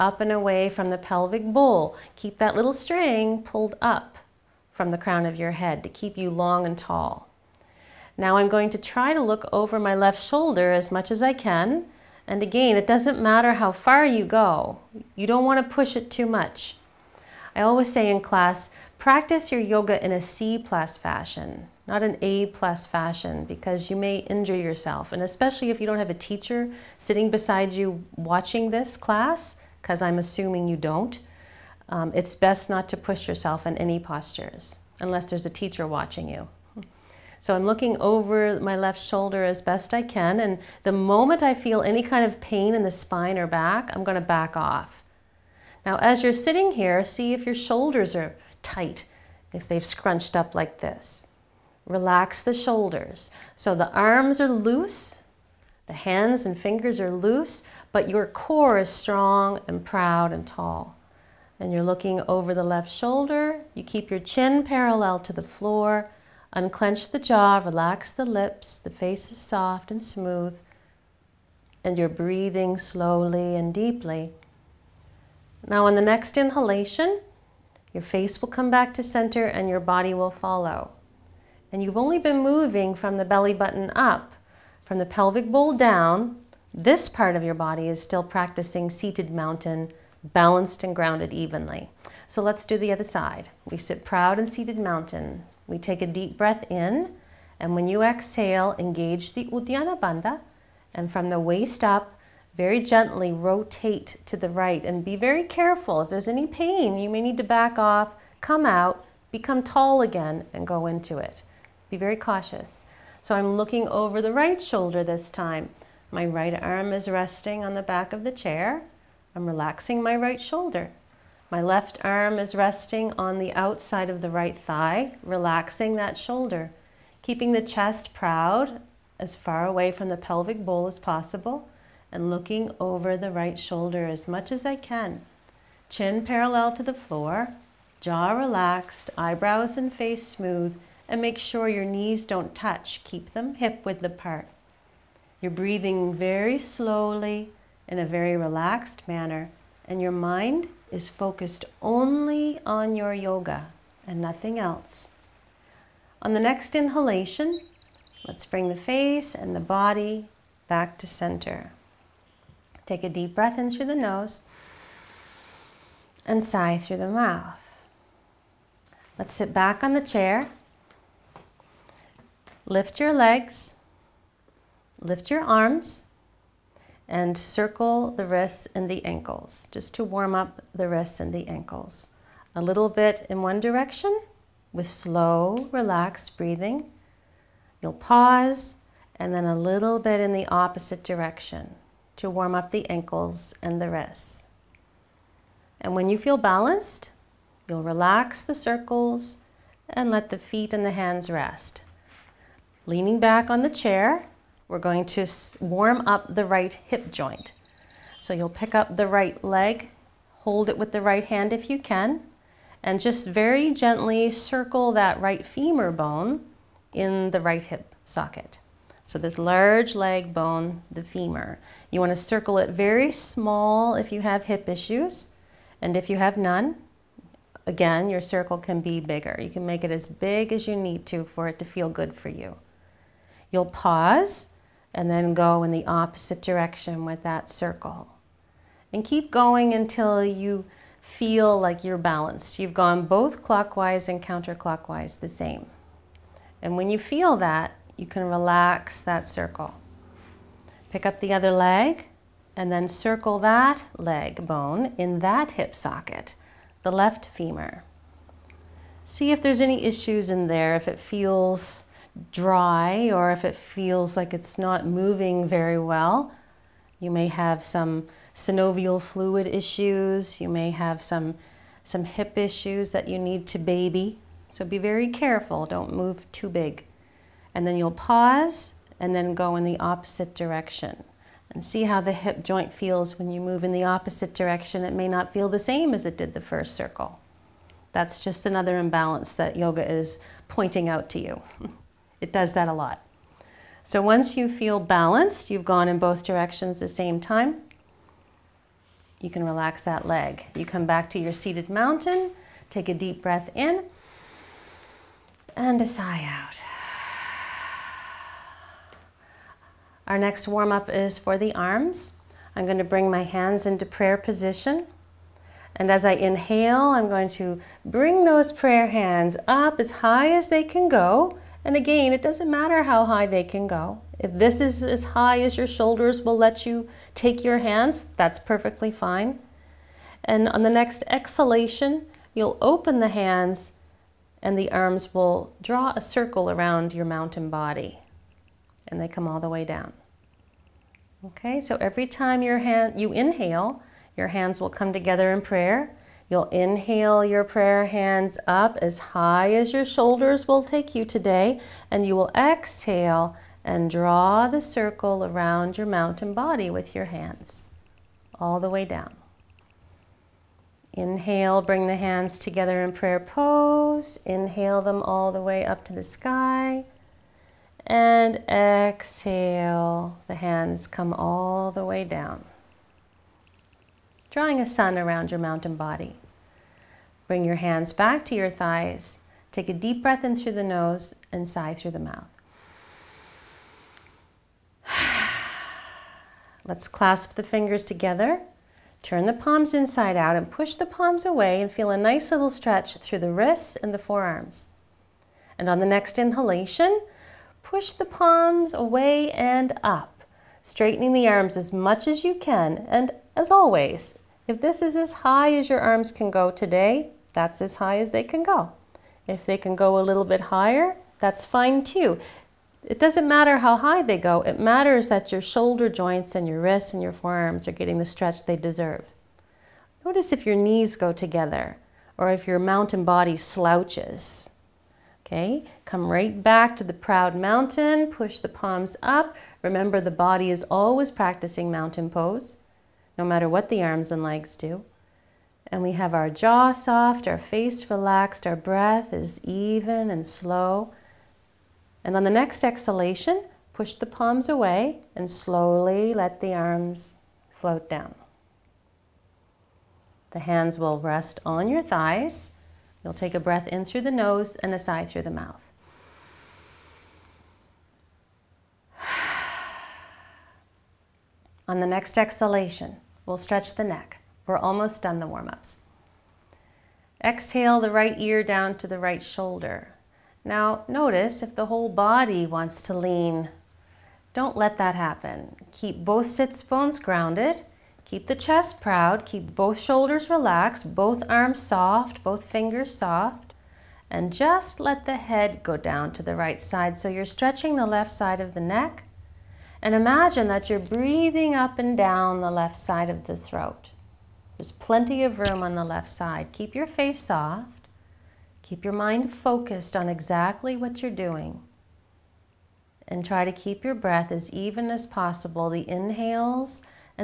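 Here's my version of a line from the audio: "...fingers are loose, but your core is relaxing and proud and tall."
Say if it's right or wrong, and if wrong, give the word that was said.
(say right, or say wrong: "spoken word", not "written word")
wrong: "strong", not "relaxing".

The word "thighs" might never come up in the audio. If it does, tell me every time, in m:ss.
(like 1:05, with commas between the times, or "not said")
2:04, 6:18, 7:31.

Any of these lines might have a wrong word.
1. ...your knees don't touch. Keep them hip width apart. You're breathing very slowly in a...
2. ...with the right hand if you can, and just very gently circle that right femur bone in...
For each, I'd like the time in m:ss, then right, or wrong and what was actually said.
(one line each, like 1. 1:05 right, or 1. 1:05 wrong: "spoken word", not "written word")
1. 2:21 right
2. 3:30 right.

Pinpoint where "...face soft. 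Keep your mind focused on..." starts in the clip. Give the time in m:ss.
8:16.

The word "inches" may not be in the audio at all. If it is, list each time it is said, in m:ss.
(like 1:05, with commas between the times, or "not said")
not said.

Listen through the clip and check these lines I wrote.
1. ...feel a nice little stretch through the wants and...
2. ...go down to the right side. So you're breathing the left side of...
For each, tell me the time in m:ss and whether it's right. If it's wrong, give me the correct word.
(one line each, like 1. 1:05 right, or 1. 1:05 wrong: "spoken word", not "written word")
1. 6:31 wrong: "wrists", not "wants"
2. 8:05 wrong: "stretching", not "breathing".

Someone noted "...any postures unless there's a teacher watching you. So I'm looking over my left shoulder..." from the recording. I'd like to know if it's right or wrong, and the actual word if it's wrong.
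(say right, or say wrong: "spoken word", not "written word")
right.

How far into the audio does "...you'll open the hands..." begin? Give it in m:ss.
5:32.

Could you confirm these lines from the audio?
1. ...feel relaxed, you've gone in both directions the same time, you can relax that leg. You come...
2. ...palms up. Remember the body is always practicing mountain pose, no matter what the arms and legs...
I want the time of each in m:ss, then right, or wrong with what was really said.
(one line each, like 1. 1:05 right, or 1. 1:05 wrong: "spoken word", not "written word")
1. 4:54 wrong: "balanced", not "relaxed"
2. 7:08 right.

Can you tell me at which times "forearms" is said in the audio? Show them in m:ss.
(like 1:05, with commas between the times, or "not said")
6:33, 6:57.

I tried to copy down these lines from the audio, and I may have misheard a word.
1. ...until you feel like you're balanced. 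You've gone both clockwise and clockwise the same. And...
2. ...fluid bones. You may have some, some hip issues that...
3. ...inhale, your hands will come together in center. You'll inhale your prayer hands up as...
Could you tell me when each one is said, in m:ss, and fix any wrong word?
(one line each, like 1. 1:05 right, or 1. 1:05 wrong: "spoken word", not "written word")
1. 3:59 wrong: "counterclockwise", not "clockwise"
2. 4:29 wrong: "issues", not "bones"
3. 5:43 wrong: "prayer", not "center".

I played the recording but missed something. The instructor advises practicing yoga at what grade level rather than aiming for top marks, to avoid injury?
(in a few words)
C plus.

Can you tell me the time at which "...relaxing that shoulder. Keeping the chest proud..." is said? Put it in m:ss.
2:05.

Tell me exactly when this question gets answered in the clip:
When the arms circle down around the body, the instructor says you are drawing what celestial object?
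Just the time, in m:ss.
6:14.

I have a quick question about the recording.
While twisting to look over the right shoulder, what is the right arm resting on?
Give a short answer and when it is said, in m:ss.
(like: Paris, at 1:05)
the back of the chair, at 1:57.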